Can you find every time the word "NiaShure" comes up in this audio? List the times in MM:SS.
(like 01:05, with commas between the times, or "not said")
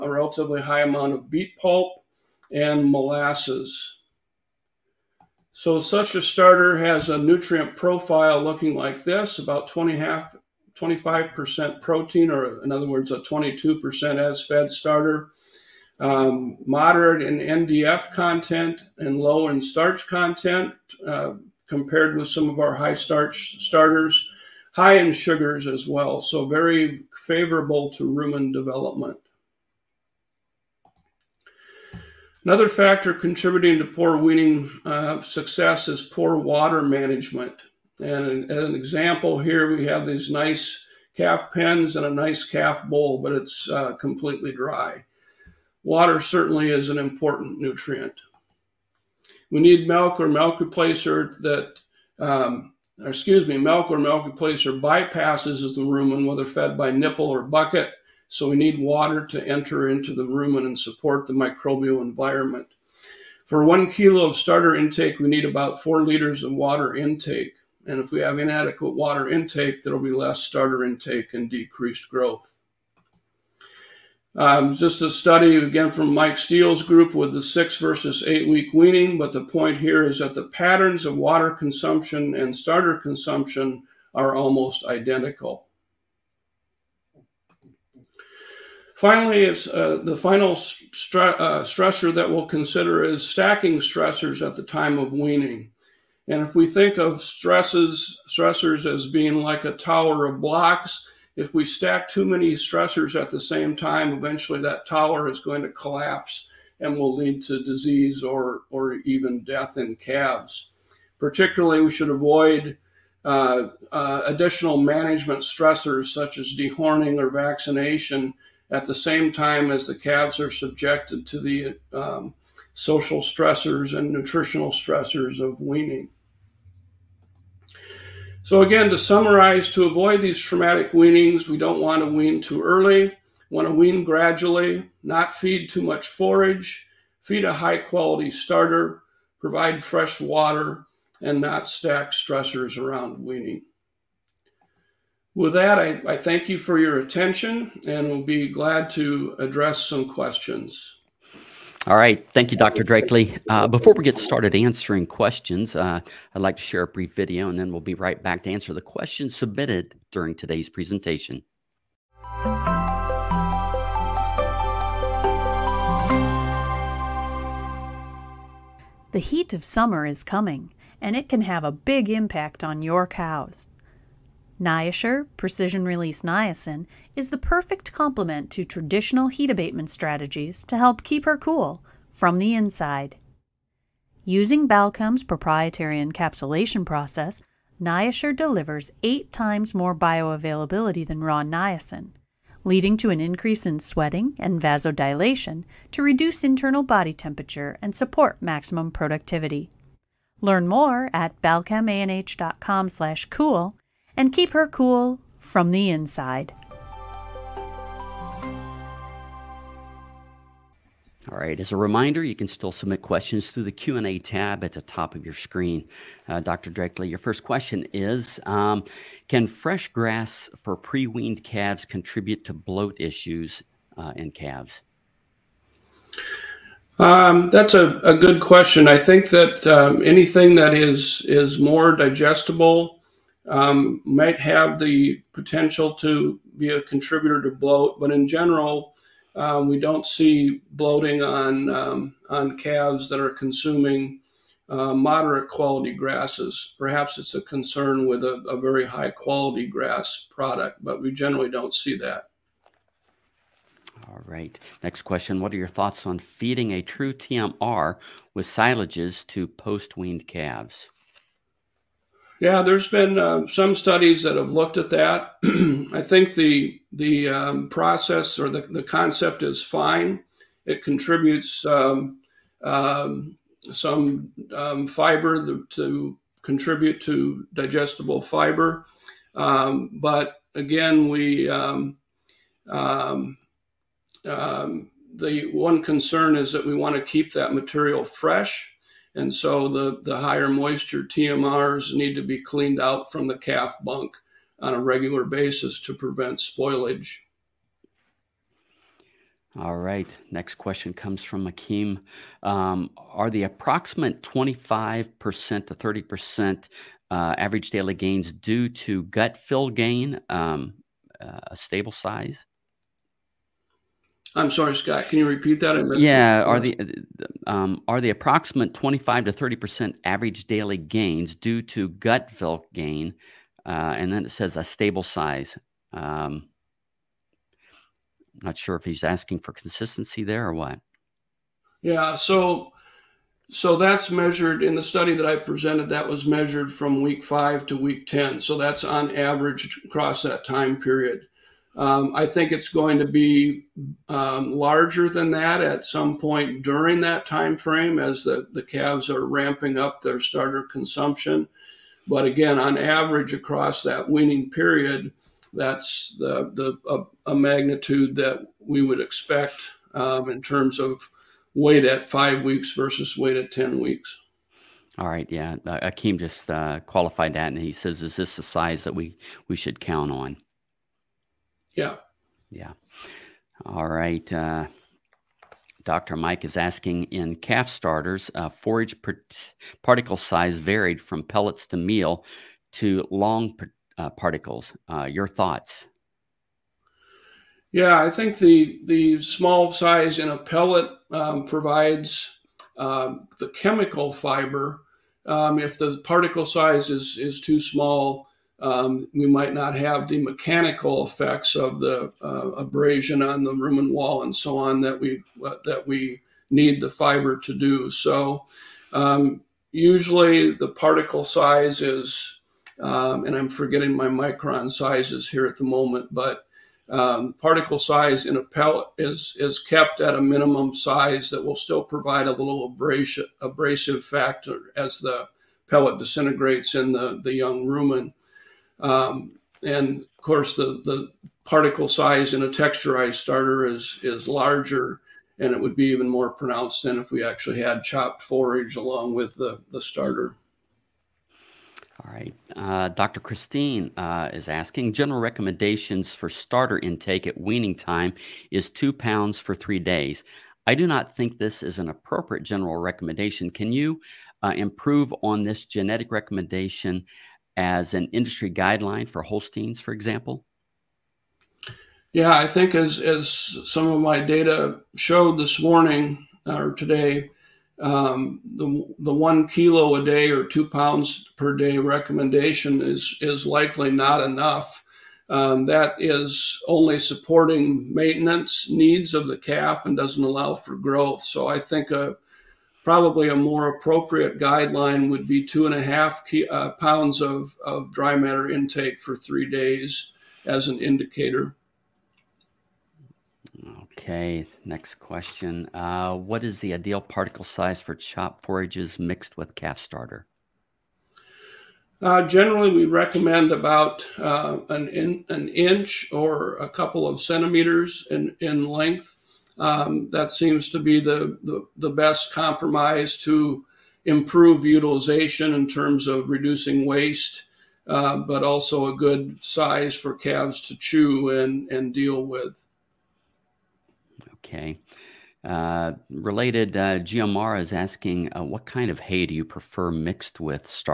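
02:54, 03:07.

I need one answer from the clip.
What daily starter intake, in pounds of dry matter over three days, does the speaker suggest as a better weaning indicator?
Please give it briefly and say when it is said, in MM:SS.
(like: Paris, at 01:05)
2.5 pounds, at 08:05.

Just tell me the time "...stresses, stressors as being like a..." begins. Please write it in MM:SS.
01:37.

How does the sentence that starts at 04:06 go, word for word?
Perhaps it's a concern with a, a very high quality grass product, but we generally don't see that.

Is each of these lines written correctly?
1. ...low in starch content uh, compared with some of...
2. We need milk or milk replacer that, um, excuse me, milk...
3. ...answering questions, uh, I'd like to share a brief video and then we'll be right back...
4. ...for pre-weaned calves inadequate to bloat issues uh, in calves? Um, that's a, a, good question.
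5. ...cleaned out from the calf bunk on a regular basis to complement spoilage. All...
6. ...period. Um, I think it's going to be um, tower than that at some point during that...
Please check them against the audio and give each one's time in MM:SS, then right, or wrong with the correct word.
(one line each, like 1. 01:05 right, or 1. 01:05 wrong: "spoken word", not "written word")
1. 00:19 right
2. 00:49 right
3. 02:34 right
4. 03:40 wrong: "contribute", not "inadequate"
5. 04:52 wrong: "prevent", not "complement"
6. 05:40 wrong: "larger", not "tower".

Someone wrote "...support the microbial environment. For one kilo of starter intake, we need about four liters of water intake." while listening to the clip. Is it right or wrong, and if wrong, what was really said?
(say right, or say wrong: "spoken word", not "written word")
right.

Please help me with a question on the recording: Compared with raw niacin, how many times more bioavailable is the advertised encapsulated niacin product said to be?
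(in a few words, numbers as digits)
8 times.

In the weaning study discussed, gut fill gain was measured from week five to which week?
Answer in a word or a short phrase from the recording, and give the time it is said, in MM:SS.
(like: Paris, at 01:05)
week 10, at 05:37.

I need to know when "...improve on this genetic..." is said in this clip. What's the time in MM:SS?
07:34.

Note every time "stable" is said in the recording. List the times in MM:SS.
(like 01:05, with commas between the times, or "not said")
05:11, 05:24.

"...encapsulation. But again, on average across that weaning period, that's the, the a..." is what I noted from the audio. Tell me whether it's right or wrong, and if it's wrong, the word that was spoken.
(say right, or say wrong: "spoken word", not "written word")
wrong: "consumption", not "encapsulation".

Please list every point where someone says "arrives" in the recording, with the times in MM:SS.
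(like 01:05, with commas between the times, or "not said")
not said.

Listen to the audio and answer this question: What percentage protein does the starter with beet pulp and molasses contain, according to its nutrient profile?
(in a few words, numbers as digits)
25%.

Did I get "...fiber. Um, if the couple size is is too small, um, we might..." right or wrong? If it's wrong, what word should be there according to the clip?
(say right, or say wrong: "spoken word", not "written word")
wrong: "particle", not "couple".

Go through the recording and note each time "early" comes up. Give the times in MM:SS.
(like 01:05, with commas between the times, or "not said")
02:12.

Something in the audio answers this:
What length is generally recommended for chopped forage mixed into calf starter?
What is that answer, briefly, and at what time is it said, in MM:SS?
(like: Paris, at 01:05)
an inch, at 08:25.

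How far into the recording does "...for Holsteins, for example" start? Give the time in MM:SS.
07:39.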